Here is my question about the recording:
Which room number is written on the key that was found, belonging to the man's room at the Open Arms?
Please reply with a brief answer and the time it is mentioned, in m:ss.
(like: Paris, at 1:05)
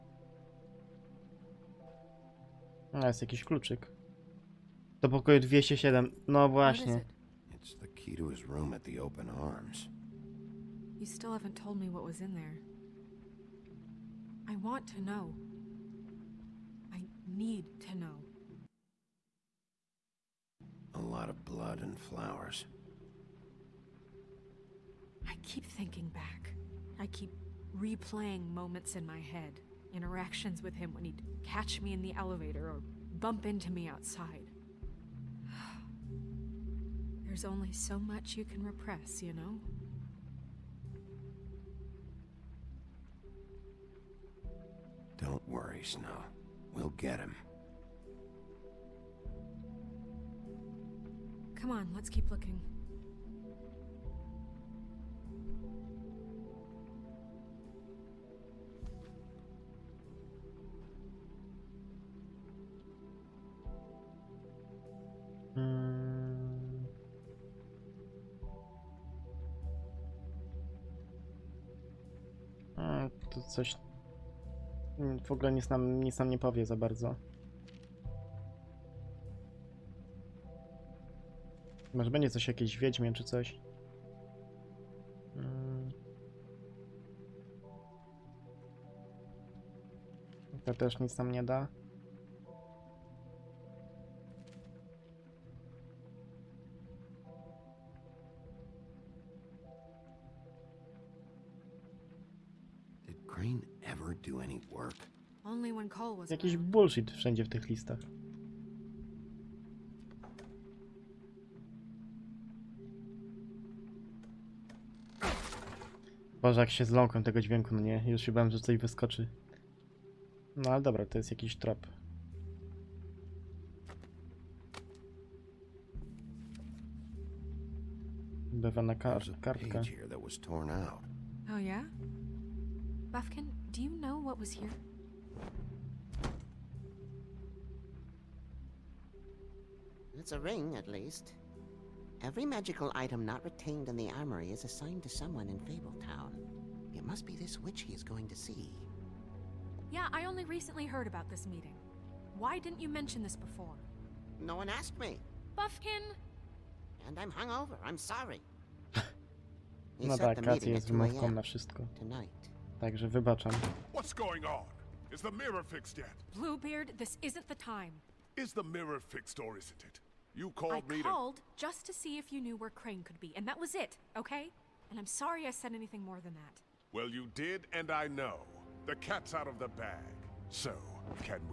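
207, at 0:05.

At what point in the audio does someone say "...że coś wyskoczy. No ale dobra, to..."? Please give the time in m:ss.
1:58.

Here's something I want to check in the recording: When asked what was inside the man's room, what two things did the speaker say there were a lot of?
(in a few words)
Blood and flowers.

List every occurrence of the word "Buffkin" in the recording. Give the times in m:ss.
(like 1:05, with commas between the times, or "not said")
2:13, 2:35.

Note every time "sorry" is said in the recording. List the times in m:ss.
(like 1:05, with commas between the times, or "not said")
2:37, 2:55.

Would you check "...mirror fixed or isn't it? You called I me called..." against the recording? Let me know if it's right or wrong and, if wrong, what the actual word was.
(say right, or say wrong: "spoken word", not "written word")
right.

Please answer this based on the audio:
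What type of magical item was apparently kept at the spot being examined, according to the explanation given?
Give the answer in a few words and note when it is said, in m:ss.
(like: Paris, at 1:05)
A ring, at 2:20.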